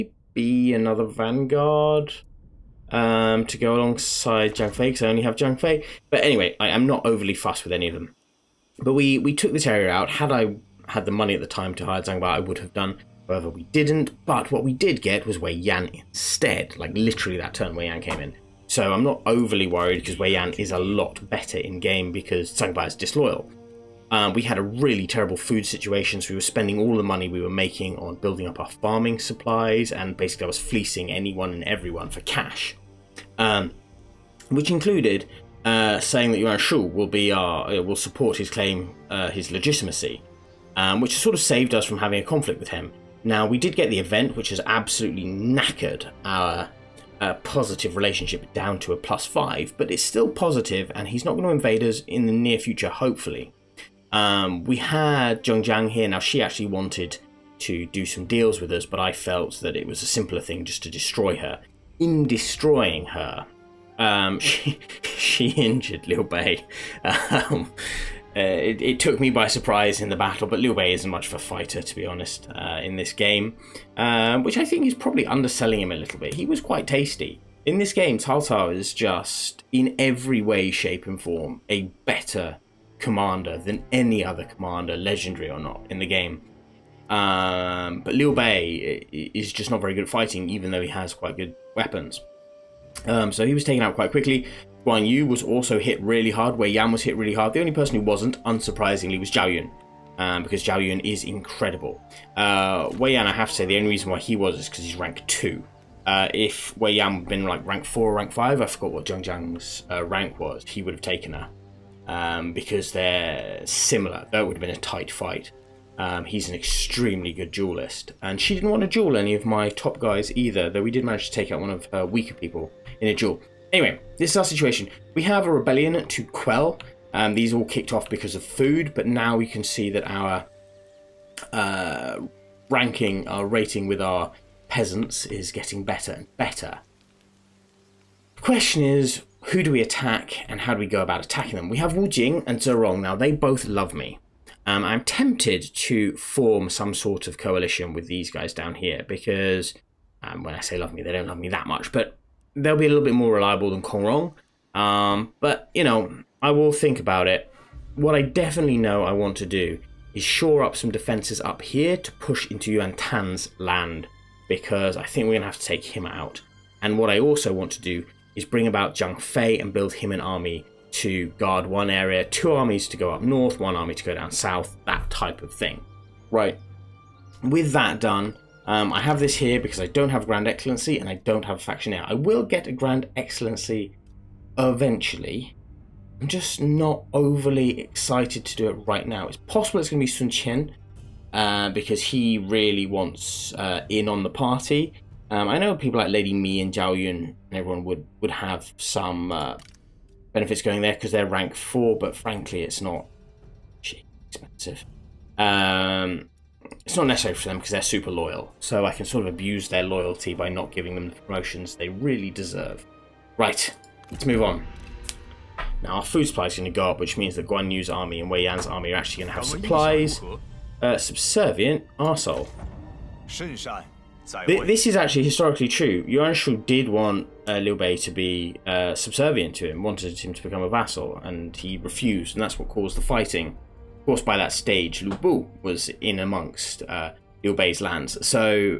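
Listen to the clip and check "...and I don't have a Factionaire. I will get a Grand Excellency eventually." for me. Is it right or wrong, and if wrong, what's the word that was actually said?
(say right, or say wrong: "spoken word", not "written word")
right.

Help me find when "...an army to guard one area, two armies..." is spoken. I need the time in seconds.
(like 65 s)
170 s.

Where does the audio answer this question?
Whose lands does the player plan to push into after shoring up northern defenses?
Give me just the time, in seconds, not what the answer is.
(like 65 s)
162 s.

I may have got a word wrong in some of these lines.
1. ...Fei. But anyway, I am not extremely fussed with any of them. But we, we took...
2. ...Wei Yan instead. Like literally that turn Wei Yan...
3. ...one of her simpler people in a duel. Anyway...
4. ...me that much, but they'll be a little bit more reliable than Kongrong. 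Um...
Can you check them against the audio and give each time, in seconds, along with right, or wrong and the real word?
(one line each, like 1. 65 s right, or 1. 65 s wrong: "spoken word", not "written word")
1. 5 s wrong: "overly", not "extremely"
2. 15 s right
3. 121 s wrong: "weaker", not "simpler"
4. 151 s right.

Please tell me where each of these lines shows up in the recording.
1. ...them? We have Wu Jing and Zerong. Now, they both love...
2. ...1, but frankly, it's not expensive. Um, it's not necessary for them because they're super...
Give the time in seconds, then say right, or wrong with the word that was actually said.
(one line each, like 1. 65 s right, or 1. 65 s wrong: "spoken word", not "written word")
1. 141 s right
2. 201 s wrong: "4", not "1".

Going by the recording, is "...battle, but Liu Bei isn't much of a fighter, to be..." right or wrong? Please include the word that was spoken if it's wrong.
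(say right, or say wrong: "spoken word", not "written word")
right.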